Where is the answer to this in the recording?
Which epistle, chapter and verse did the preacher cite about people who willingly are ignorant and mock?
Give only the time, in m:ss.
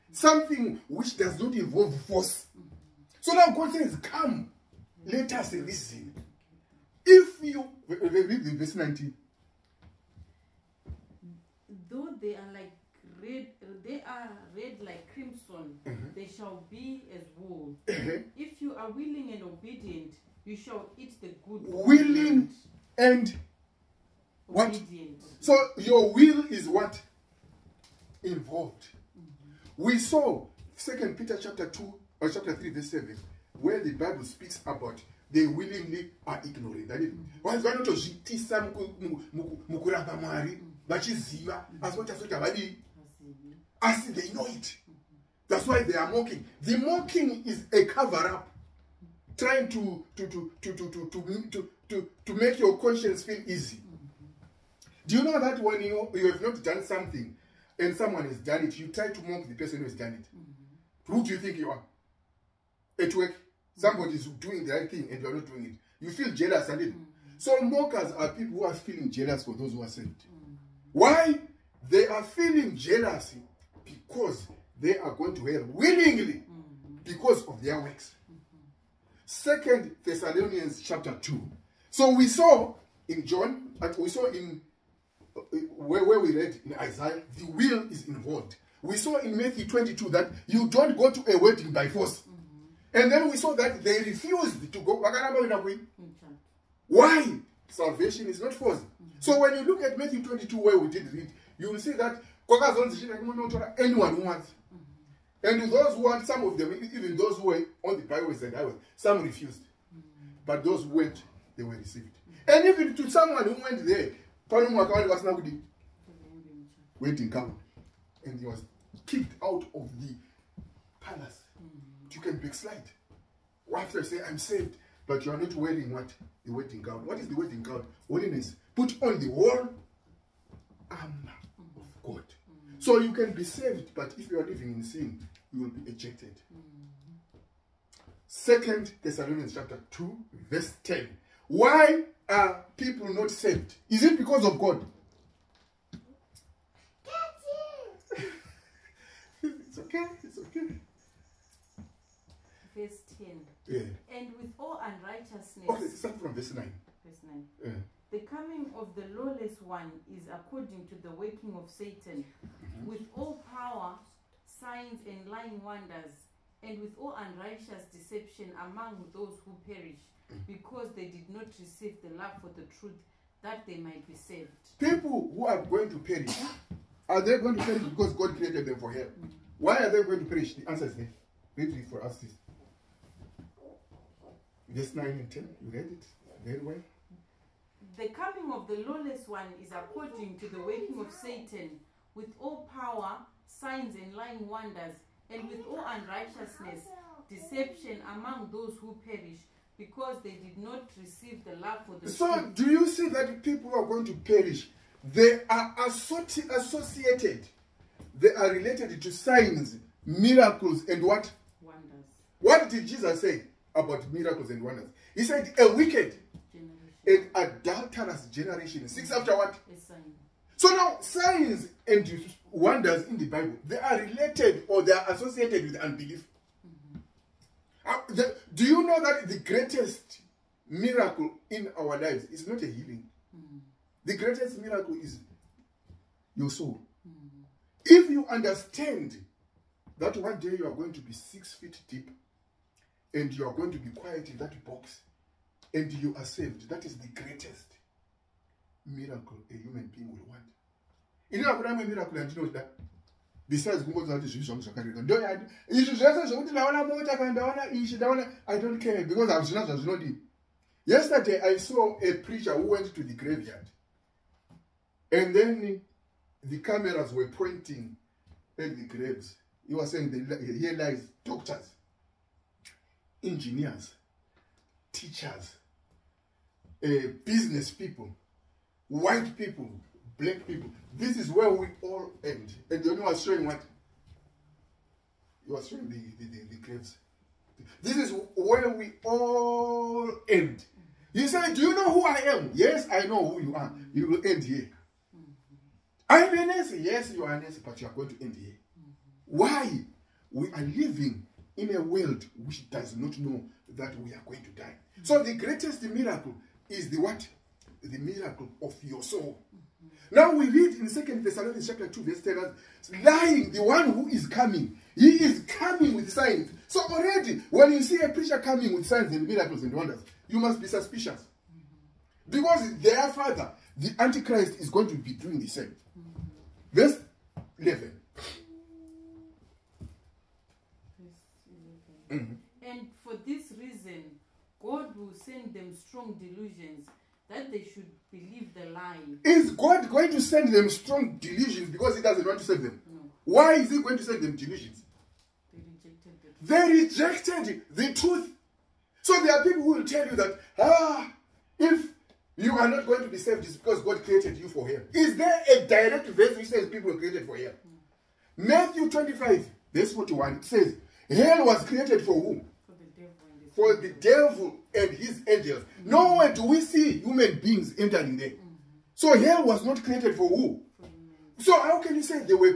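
0:30.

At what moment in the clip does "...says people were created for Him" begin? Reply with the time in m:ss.
5:56.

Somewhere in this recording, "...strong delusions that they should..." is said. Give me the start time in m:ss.
5:35.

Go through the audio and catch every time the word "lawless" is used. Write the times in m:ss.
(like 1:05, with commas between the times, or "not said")
2:39, 3:08.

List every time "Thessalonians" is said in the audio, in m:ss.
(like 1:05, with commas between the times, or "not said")
1:20, 2:19, 5:11.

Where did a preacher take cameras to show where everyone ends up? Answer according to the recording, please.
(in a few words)
The graveyard.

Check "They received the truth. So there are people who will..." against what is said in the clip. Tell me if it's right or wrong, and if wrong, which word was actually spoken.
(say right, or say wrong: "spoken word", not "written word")
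wrong: "rejected", not "received".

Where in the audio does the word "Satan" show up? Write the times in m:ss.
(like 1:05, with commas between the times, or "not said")
2:41, 3:11.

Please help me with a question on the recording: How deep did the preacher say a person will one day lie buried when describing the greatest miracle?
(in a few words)
6 feet.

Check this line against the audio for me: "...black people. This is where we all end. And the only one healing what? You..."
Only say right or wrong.
wrong.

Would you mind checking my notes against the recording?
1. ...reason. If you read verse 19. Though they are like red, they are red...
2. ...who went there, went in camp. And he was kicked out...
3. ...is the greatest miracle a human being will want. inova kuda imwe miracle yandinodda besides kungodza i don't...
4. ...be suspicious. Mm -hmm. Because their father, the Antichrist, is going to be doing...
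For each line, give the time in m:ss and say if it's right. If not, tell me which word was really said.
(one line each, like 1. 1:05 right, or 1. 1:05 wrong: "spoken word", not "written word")
1. 0:05 right
2. 1:53 right
3. 4:06 right
4. 5:20 right.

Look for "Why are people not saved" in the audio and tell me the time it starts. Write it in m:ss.
2:21.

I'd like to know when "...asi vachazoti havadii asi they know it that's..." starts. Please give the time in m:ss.
0:41.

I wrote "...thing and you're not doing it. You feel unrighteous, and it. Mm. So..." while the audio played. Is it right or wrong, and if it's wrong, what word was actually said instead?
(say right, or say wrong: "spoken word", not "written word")
wrong: "jealous", not "unrighteous".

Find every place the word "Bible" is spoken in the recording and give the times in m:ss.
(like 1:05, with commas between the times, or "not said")
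0:33, 3:43.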